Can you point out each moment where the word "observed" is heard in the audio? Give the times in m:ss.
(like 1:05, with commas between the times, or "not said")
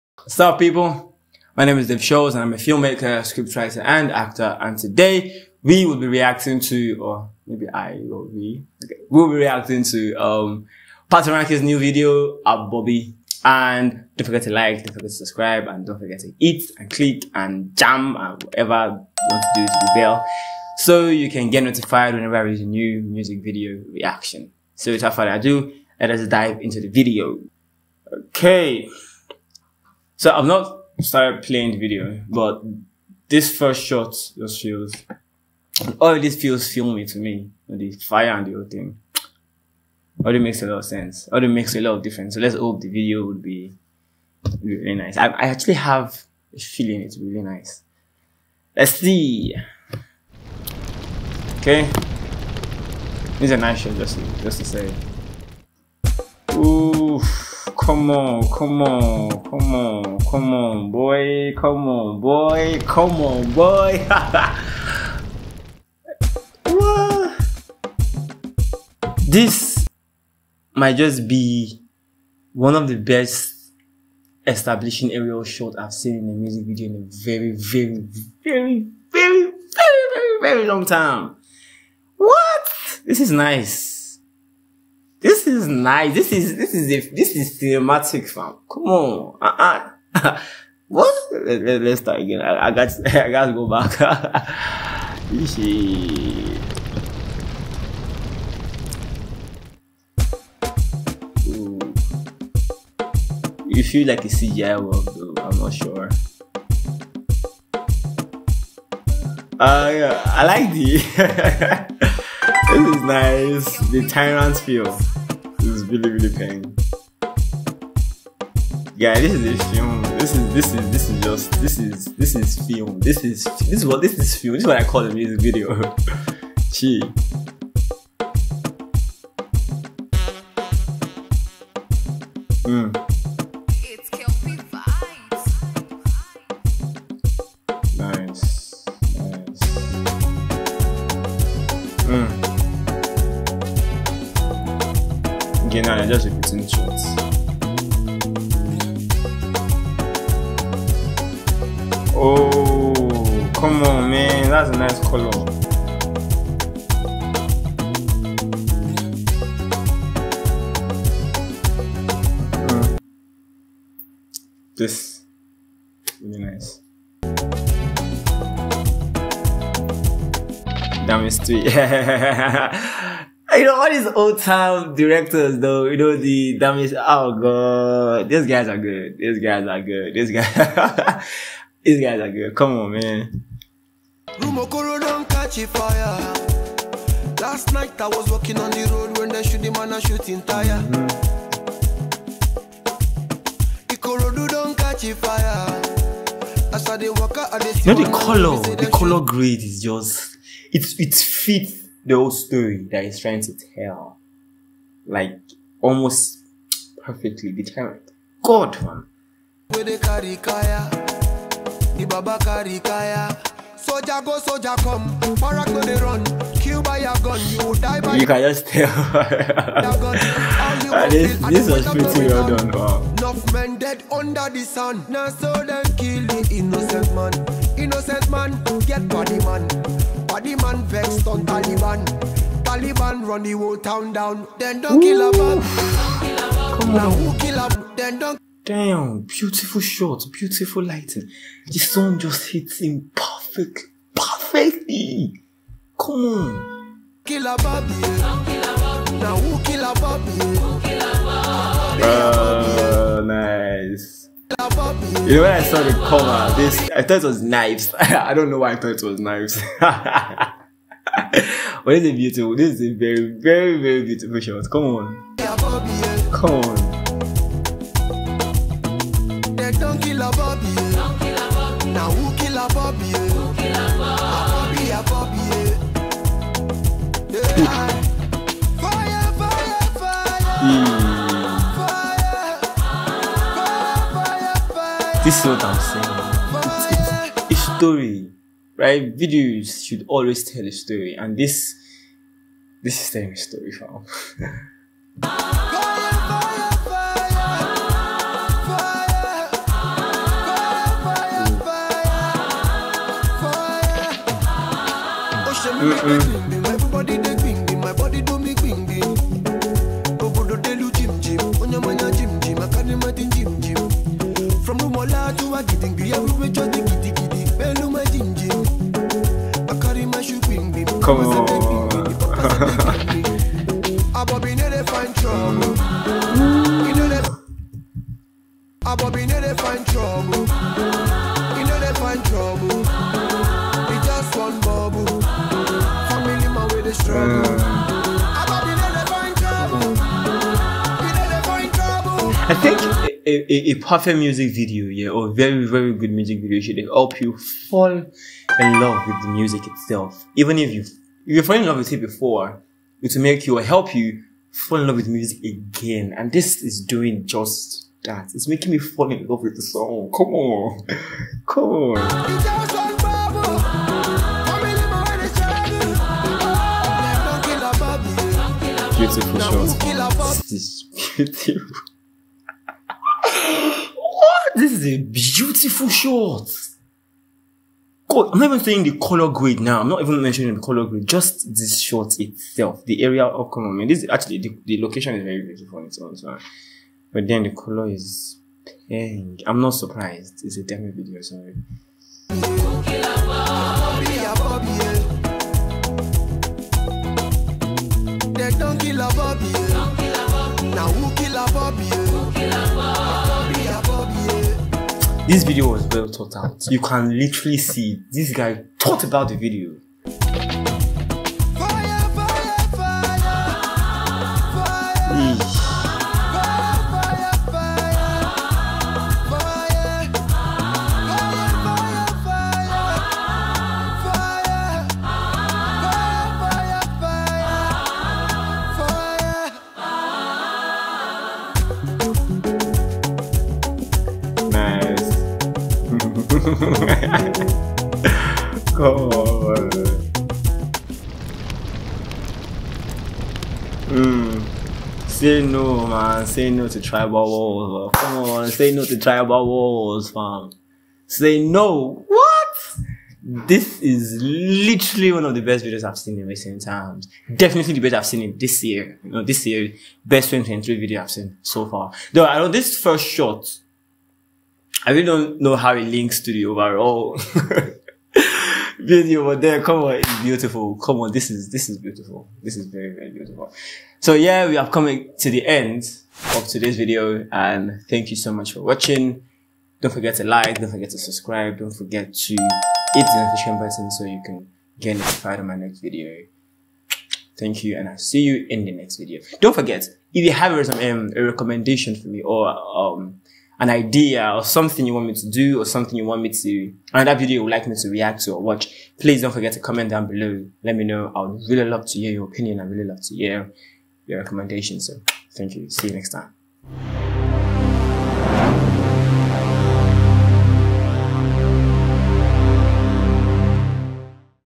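not said.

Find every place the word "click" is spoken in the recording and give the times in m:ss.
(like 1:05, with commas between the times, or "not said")
0:16.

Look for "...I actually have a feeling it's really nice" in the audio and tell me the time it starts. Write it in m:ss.
0:45.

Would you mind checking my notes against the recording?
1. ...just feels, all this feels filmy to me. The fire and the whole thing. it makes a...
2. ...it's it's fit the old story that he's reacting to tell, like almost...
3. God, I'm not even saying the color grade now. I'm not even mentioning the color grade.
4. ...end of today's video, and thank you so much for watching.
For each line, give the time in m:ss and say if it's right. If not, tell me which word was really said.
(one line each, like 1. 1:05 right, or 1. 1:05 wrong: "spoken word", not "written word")
1. 0:34 right
2. 3:20 wrong: "trying", not "reacting"
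3. 6:18 right
4. 7:55 right.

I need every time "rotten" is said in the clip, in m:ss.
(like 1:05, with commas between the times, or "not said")
not said.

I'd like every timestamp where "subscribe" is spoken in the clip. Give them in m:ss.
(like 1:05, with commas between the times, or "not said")
0:15, 8:00.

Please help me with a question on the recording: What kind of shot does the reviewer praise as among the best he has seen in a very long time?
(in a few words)
Establishing aerial shots.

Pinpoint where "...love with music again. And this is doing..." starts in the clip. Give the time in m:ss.
5:54.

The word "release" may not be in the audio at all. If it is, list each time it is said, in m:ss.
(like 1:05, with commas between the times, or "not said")
0:22.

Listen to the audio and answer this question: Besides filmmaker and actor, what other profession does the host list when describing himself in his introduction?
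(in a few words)
Scriptwriter.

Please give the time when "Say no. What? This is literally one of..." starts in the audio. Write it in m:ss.
7:31.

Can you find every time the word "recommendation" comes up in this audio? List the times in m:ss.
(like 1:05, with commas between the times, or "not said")
8:11, 8:24.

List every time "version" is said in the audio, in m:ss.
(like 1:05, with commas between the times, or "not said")
not said.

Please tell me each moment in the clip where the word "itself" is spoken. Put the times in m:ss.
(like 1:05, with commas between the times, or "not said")
5:49, 6:22.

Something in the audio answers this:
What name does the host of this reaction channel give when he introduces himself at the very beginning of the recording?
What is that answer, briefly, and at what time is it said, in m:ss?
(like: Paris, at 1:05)
Dave Shorlz, at 0:01.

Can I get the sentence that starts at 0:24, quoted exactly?
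So without further ado, let us dive into the video.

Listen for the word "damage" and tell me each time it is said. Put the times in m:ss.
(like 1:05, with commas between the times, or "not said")
2:56.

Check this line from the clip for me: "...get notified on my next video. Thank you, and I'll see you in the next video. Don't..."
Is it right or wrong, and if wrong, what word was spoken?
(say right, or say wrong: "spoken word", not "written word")
right.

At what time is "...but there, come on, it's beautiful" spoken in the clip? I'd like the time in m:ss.
7:49.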